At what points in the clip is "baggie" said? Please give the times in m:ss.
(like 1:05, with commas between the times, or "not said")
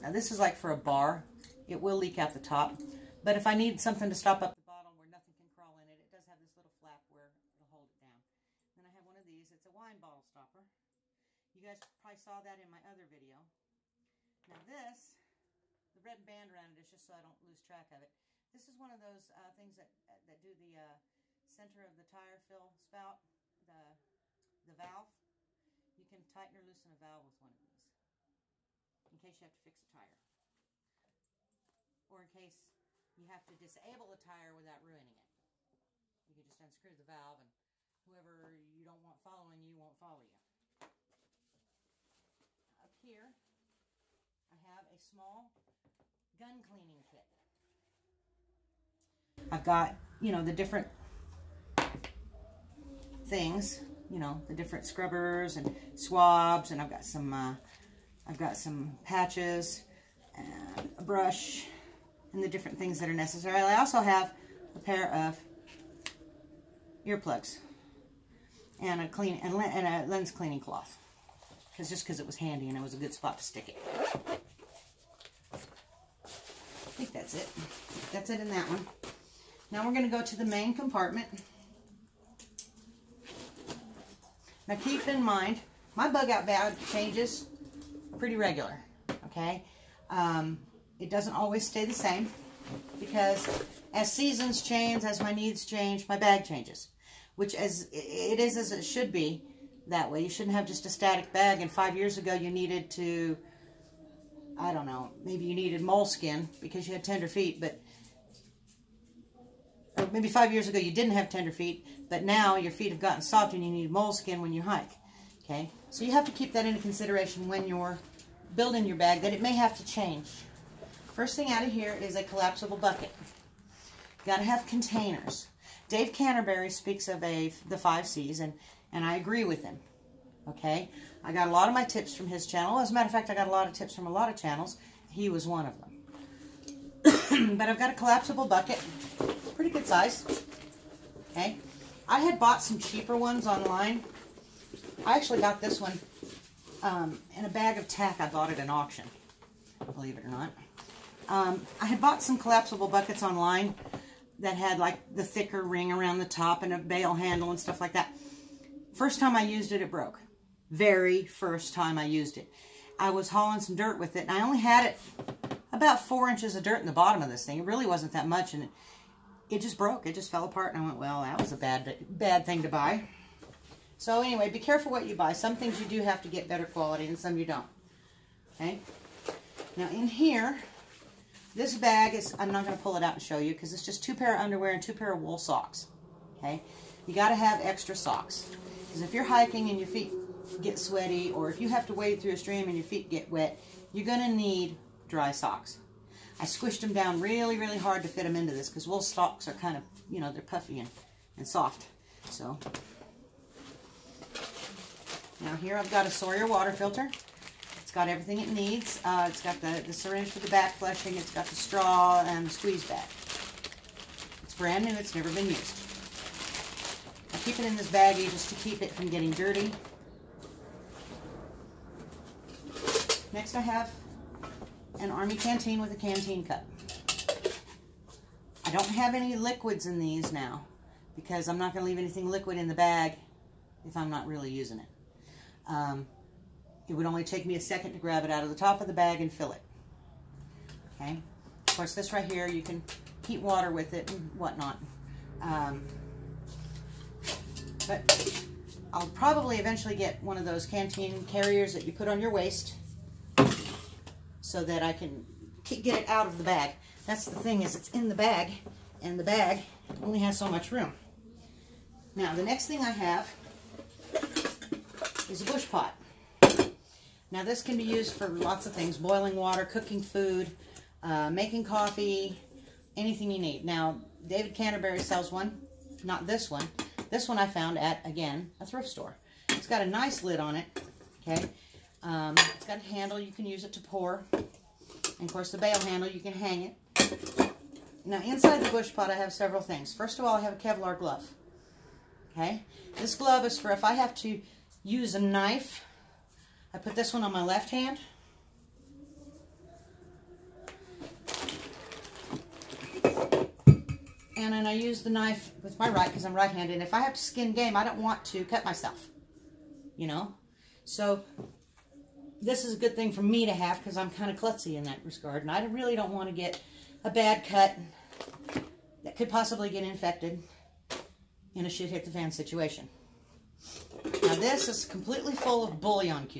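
3:37.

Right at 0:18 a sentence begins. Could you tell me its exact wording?
This is one of those uh, things that uh, that do the uh, center of the tire fill spout, the, the valve.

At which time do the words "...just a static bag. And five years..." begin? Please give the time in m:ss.
1:40.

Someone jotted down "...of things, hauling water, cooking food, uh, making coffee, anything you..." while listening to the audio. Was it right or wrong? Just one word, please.
wrong.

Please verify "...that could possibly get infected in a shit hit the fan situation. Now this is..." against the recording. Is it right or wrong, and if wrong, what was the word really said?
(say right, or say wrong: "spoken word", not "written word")
right.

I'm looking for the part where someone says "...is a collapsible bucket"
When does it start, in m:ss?
2:02.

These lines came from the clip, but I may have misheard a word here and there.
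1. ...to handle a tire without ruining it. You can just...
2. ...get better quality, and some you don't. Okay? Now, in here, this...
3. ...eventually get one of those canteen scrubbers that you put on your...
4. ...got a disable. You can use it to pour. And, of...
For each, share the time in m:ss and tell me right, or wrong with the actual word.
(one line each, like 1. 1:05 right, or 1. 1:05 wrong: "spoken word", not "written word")
1. 0:33 wrong: "disable", not "handle"
2. 2:56 right
3. 4:09 wrong: "carriers", not "scrubbers"
4. 4:42 wrong: "handle", not "disable".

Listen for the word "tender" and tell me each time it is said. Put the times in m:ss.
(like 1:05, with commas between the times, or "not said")
1:47, 1:51.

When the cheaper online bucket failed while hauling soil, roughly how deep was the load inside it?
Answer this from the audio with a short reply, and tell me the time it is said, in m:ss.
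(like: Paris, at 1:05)
4 inches, at 2:46.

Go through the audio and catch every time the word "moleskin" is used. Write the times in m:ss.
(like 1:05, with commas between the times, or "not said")
1:45, 1:53.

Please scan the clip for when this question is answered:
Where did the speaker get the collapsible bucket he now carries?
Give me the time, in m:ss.
2:28.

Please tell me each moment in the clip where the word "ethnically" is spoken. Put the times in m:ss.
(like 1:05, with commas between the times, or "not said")
not said.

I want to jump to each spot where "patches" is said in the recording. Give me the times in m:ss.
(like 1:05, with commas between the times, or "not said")
0:59.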